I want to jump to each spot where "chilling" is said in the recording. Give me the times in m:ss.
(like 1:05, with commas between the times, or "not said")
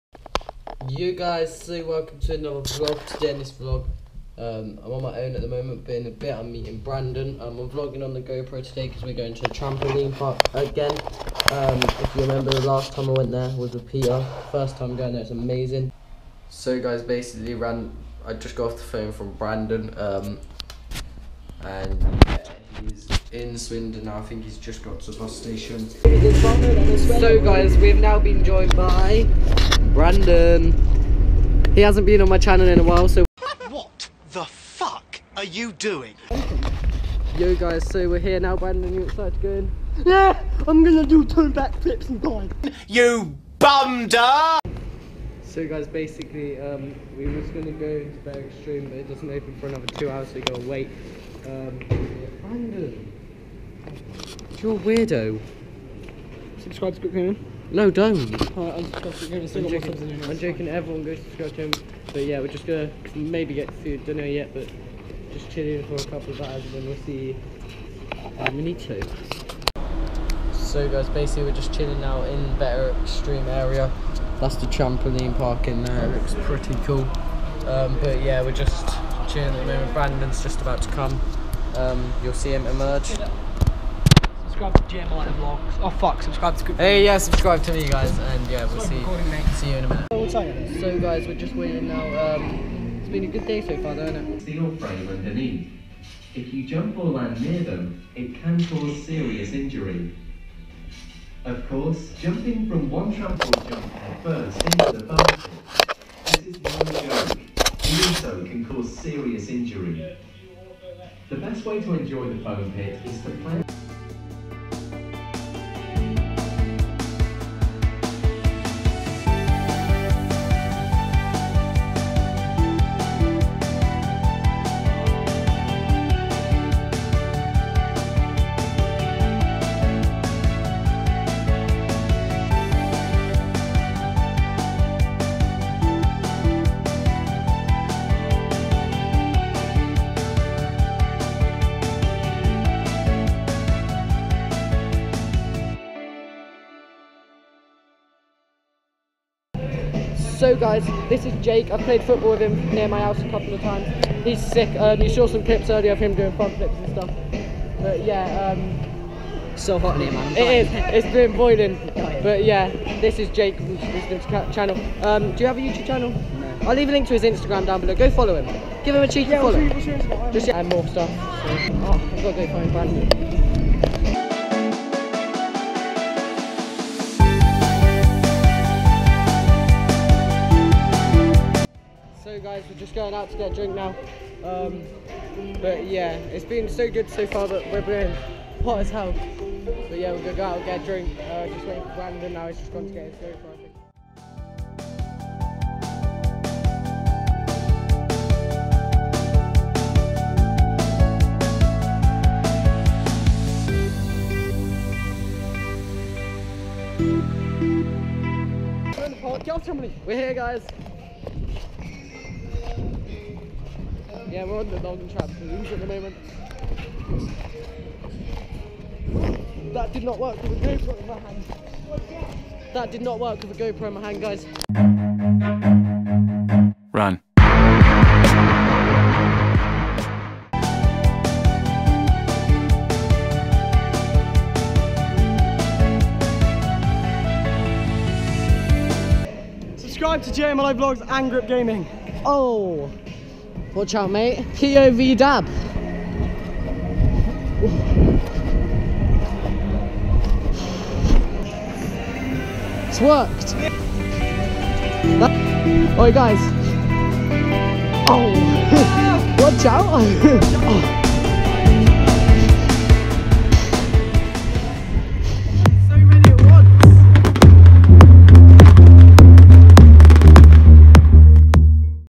1:05, 1:11, 1:19.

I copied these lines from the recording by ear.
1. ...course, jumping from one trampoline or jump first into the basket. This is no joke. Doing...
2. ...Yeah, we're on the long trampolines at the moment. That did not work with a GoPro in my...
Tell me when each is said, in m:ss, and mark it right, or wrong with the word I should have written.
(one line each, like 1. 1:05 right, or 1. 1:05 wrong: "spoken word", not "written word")
1. 1:41 right
2. 3:34 right.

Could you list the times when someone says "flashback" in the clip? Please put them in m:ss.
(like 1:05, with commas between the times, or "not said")
not said.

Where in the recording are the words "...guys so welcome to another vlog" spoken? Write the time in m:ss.
0:01.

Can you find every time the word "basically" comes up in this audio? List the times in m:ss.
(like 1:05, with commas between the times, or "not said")
0:17, 0:45, 1:11.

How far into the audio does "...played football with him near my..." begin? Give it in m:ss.
2:31.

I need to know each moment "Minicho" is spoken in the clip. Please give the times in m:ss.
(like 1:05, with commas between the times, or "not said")
1:08.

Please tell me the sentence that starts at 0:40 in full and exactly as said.
Yeah, I'm gonna do two back flips and die.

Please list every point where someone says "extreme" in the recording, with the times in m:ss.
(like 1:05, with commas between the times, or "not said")
0:48, 1:13.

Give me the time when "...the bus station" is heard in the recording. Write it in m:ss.
0:25.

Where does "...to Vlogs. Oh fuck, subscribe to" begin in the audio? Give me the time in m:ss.
1:25.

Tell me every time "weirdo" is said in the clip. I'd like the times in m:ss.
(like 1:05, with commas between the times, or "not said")
0:54.